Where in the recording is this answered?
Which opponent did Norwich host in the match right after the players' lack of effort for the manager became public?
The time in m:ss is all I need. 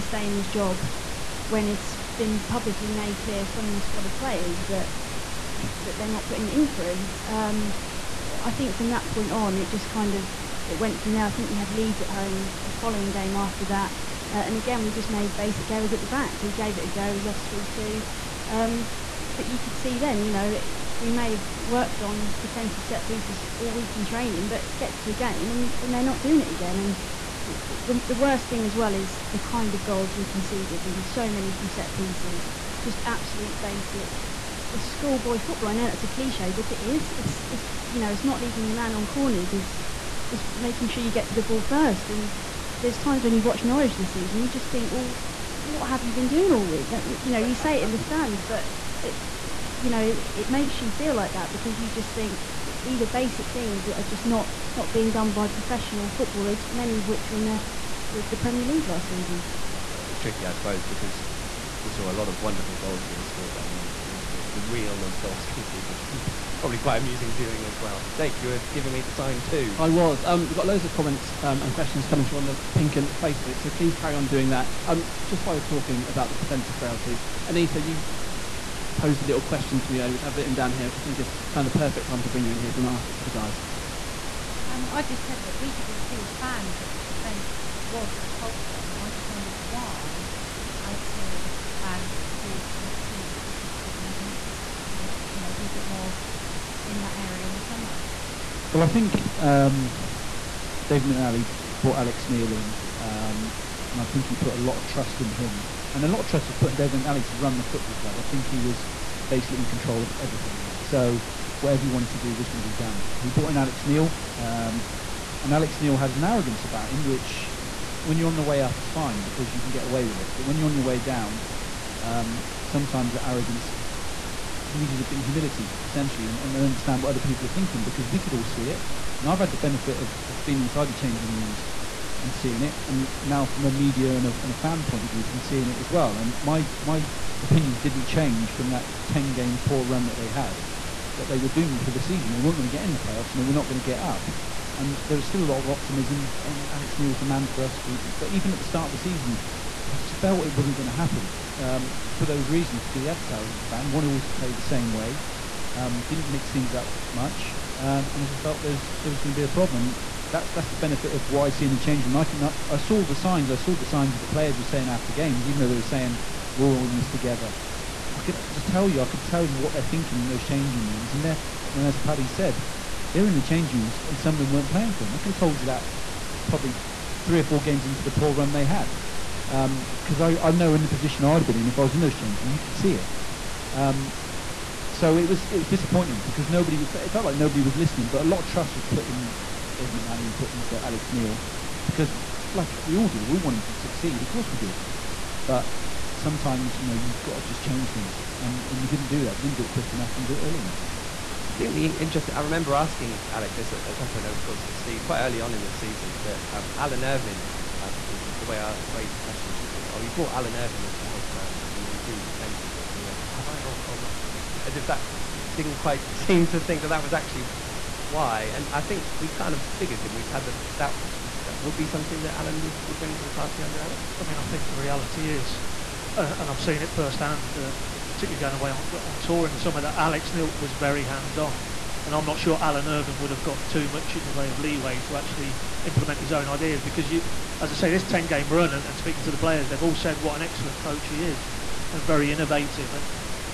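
0:11.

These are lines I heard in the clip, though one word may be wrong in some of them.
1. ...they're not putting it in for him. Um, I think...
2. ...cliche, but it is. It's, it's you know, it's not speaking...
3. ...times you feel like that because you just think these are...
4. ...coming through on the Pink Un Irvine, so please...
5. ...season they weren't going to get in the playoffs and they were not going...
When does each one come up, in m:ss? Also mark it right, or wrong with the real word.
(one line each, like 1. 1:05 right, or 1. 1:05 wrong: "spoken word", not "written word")
1. 0:05 right
2. 0:36 wrong: "leaving", not "speaking"
3. 0:50 wrong: "makes", not "times"
4. 1:12 wrong: "Facebook", not "Irvine"
5. 2:21 right.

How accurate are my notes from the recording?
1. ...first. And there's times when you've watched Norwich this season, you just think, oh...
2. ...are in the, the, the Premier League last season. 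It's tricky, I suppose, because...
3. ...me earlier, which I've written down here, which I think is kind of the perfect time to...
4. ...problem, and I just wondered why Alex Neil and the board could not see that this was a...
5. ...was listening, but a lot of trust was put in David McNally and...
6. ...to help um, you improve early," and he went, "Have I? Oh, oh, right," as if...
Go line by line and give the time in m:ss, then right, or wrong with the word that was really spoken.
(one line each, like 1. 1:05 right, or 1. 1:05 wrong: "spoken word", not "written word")
1. 0:41 right
2. 0:57 right
3. 1:19 right
4. 1:28 right
5. 3:07 right
6. 3:30 wrong: "defensively", not "early".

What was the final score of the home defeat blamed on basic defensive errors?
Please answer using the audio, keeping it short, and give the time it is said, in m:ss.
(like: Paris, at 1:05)
3-2, at 0:17.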